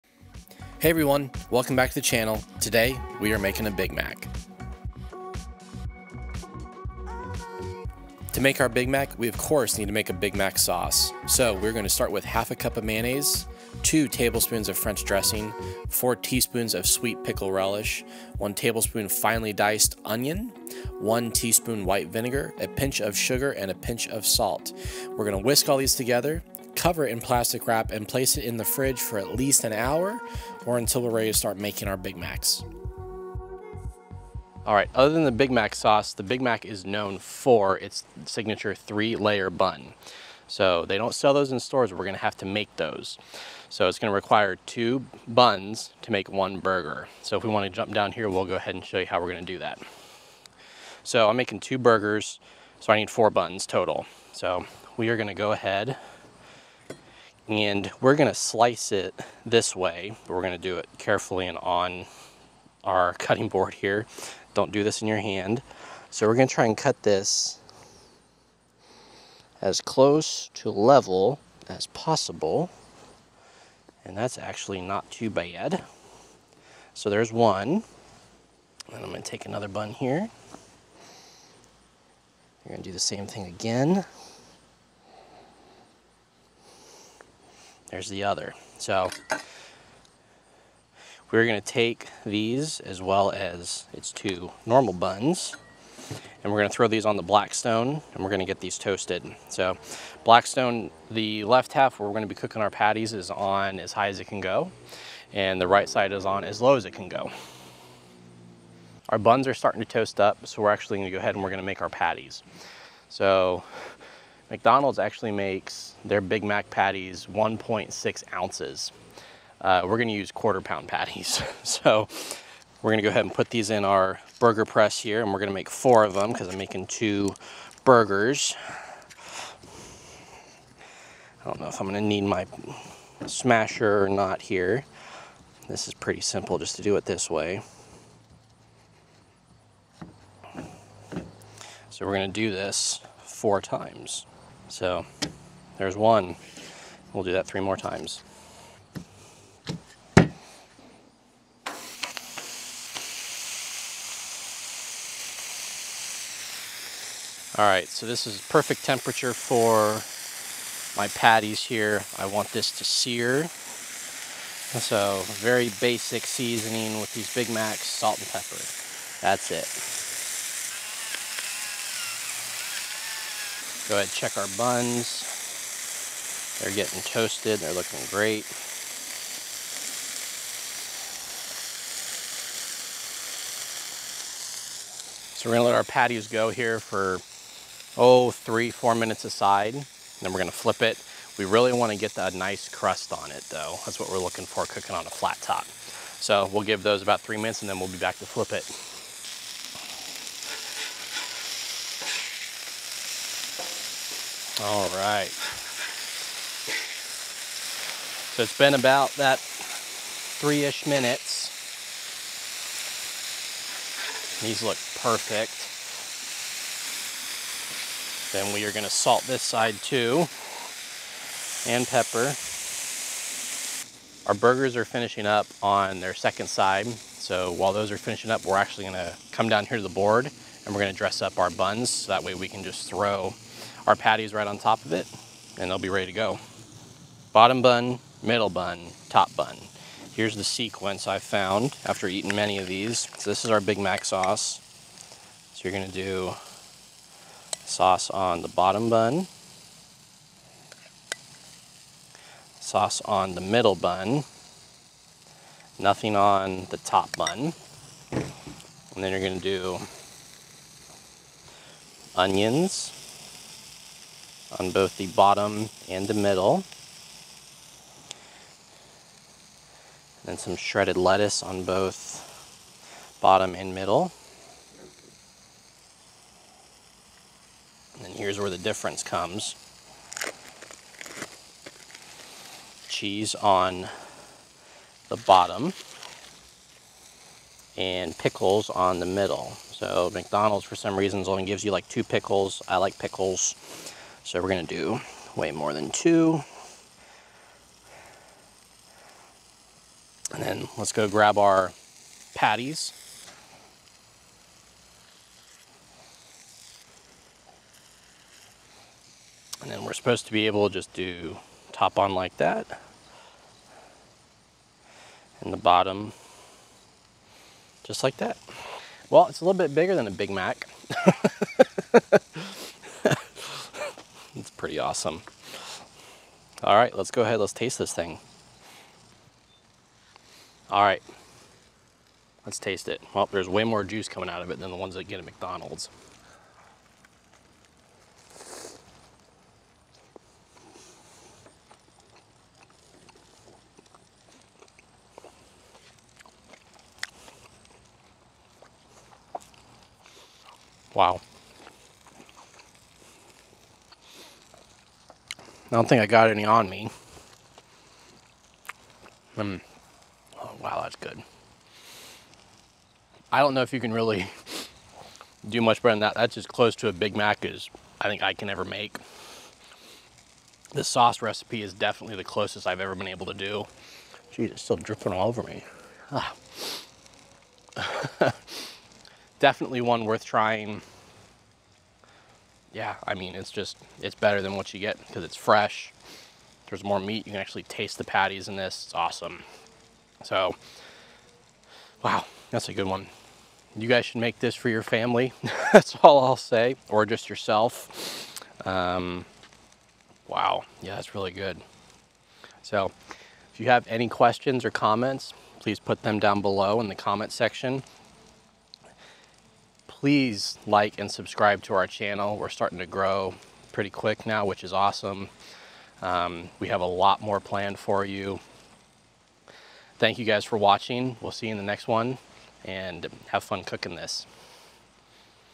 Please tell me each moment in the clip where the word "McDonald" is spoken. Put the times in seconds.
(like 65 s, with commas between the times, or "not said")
114 s, 290 s, 335 s.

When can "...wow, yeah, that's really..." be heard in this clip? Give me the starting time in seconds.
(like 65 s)
400 s.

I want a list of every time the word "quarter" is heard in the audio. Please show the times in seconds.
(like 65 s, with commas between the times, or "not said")
120 s.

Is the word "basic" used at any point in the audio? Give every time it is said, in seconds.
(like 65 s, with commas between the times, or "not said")
165 s.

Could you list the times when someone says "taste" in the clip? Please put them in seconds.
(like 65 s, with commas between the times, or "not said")
327 s, 332 s, 387 s.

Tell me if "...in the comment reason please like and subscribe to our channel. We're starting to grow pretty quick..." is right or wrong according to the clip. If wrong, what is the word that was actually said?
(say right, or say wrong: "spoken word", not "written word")
wrong: "section", not "reason".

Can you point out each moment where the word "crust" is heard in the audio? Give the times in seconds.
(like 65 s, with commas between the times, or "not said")
192 s.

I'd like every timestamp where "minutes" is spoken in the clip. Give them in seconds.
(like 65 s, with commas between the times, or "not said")
188 s, 197 s, 210 s.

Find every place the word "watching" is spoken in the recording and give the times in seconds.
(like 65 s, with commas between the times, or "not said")
420 s.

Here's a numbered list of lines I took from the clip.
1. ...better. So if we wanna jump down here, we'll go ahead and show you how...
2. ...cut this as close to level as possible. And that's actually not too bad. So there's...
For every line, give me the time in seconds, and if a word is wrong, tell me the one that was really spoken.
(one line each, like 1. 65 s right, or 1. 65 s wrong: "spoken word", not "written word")
1. 46 s wrong: "burger", not "better"
2. 66 s right.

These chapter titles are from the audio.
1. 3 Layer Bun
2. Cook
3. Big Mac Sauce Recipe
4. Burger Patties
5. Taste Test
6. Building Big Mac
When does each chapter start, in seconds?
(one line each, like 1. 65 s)
1. 44 s
2. 151 s
3. 10 s
4. 107 s
5. 323 s
6. 235 s.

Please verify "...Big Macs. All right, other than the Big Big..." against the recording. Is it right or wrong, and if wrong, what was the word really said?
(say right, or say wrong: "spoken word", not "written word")
wrong: "Mac", not "Big".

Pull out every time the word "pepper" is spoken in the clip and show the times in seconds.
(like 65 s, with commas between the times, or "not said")
168 s, 221 s.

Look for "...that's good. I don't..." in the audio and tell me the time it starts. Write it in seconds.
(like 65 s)
360 s.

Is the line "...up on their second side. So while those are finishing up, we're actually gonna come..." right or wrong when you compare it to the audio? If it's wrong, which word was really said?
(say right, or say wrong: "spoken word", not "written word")
right.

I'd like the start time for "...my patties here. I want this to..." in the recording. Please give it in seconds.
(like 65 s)
160 s.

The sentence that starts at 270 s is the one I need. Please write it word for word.
And some shredded lettuce on both bottom and middle.